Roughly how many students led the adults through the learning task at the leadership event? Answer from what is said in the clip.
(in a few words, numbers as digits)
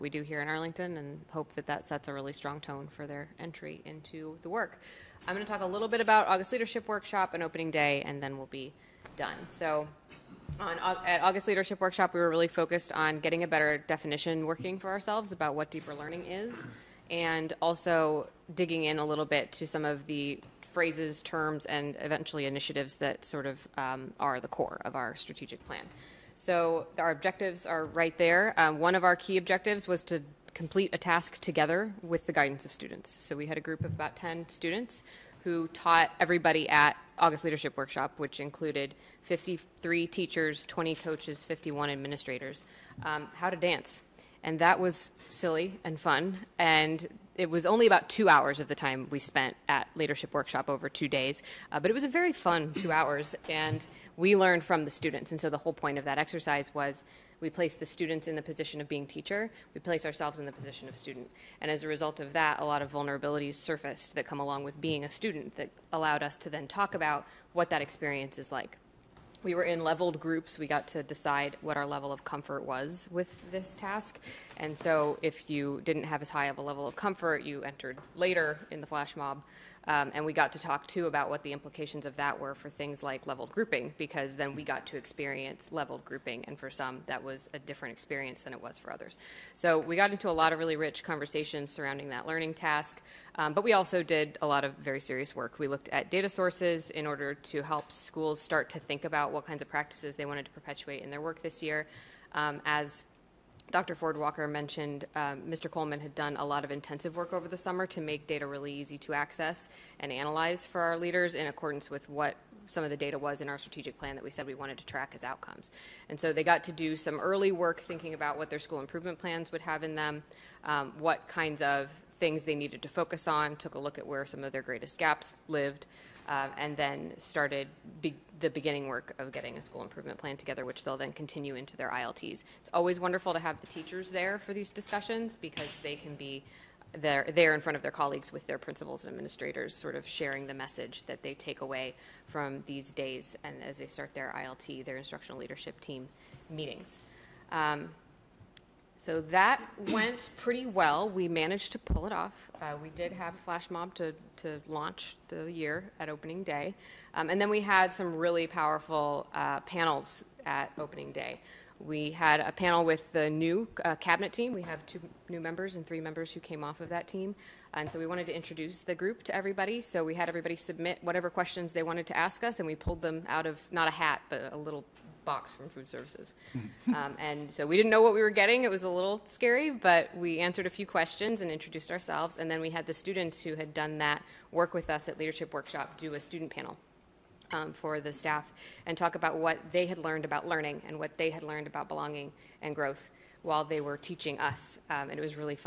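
10.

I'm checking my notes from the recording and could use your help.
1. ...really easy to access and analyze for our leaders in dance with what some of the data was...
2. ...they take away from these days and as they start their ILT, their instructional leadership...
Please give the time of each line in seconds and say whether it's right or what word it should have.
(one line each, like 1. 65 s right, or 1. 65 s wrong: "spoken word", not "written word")
1. 108 s wrong: "accordance", not "dance"
2. 141 s right.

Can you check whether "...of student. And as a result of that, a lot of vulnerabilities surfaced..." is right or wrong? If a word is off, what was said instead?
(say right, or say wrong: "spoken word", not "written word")
right.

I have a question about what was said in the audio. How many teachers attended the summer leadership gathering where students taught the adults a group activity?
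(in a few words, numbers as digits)
53.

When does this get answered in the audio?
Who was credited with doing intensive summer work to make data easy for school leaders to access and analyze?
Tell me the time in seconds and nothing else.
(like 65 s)
105 s.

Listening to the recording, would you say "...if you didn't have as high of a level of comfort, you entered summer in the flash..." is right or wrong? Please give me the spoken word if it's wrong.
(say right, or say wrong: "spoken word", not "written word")
wrong: "later", not "summer".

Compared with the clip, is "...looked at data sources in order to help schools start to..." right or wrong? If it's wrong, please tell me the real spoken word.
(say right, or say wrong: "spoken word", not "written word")
right.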